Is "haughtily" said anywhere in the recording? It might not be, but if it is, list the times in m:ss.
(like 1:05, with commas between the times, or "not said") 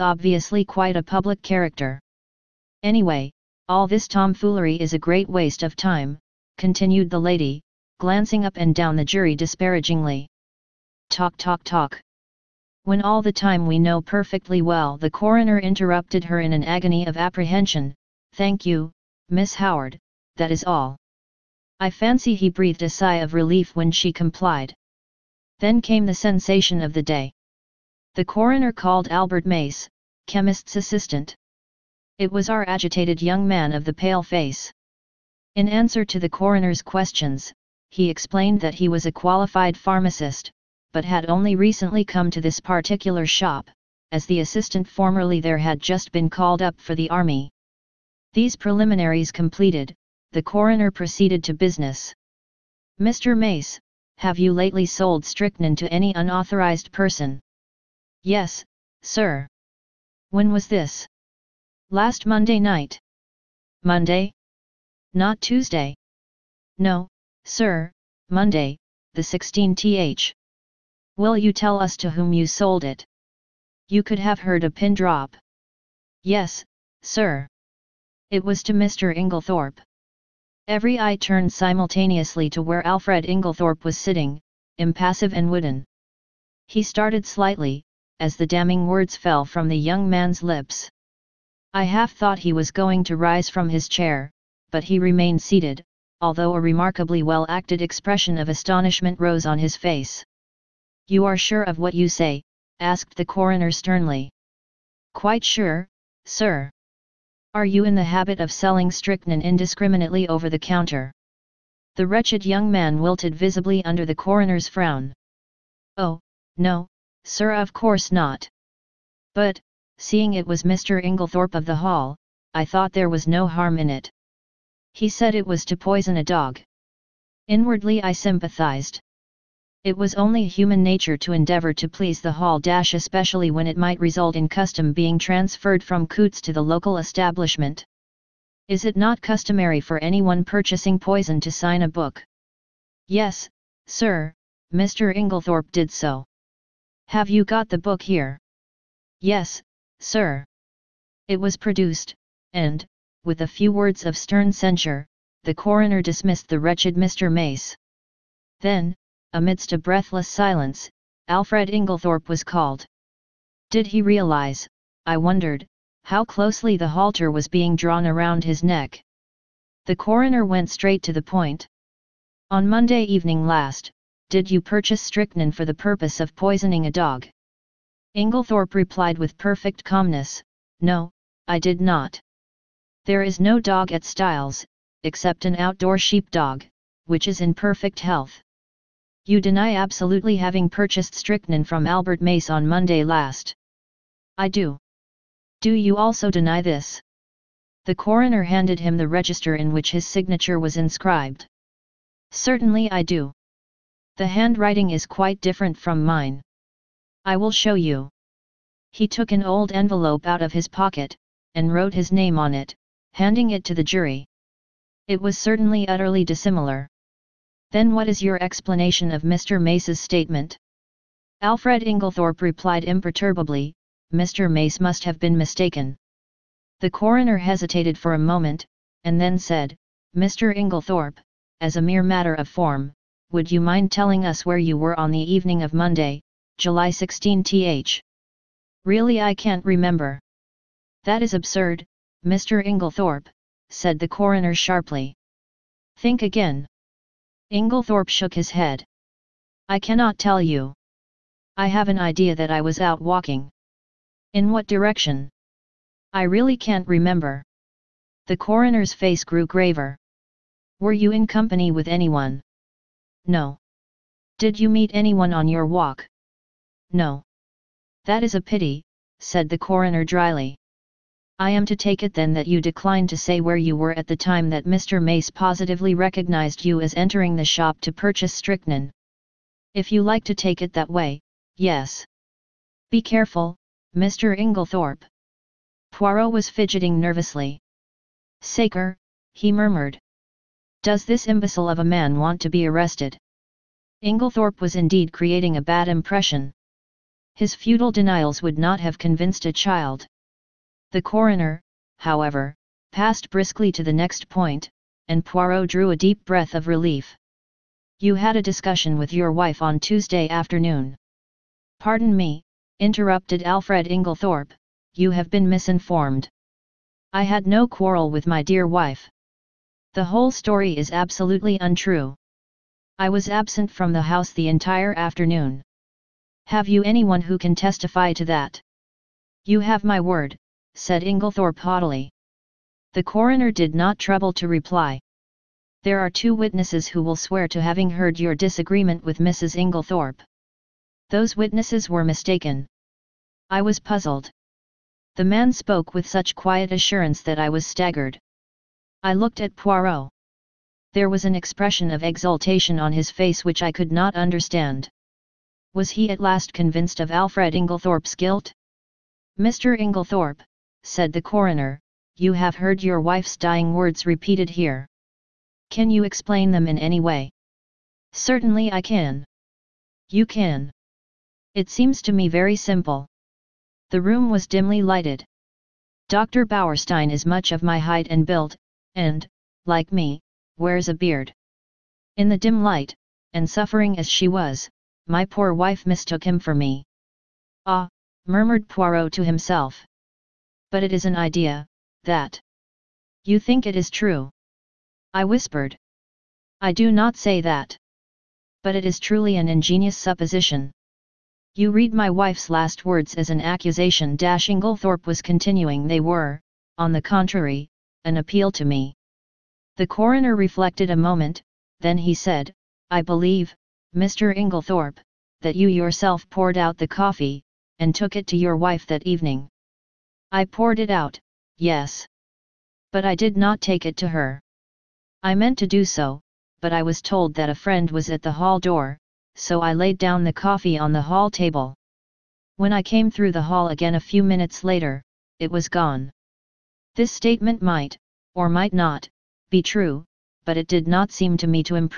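5:31.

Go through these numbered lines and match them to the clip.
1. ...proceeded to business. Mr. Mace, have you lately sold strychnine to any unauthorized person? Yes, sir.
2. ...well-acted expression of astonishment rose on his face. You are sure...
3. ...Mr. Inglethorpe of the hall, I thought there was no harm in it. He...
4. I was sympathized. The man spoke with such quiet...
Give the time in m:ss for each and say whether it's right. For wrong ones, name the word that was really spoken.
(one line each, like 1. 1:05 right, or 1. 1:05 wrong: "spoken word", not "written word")
1. 0:50 right
2. 1:37 right
3. 2:00 right
4. 5:43 wrong: "puzzled", not "sympathized".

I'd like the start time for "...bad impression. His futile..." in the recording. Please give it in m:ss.
4:55.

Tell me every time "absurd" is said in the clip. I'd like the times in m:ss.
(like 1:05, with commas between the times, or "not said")
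4:01.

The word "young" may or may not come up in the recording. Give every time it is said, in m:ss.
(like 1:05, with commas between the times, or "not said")
0:33, 1:29, 1:52.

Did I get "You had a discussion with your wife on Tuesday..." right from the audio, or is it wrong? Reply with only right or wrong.
right.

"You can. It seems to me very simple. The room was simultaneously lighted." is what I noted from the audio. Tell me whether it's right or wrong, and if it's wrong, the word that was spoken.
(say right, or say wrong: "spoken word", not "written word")
wrong: "dimly", not "simultaneously".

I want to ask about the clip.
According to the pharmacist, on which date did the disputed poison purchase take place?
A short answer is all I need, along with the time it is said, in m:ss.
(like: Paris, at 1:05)
Monday, the 16th, at 1:08.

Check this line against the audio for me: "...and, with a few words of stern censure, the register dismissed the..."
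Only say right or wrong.
wrong.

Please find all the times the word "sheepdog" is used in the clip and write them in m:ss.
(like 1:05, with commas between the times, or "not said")
3:05.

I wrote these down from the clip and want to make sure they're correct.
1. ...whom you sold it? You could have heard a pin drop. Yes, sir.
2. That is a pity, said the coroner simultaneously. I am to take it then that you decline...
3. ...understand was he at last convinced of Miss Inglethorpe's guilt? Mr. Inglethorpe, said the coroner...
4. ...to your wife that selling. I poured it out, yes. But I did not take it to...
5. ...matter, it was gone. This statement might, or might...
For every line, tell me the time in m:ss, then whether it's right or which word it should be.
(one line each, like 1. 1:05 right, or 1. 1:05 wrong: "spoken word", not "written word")
1. 1:12 right
2. 4:28 wrong: "dryly", not "simultaneously"
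3. 5:54 wrong: "Alfred", not "Miss"
4. 6:58 wrong: "evening", not "selling"
5. 7:14 wrong: "later", not "matter".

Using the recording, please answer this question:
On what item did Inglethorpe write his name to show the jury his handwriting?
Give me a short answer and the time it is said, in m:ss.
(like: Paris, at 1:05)
An old envelope, at 3:29.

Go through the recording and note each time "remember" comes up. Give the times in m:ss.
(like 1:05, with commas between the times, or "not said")
3:59, 4:16.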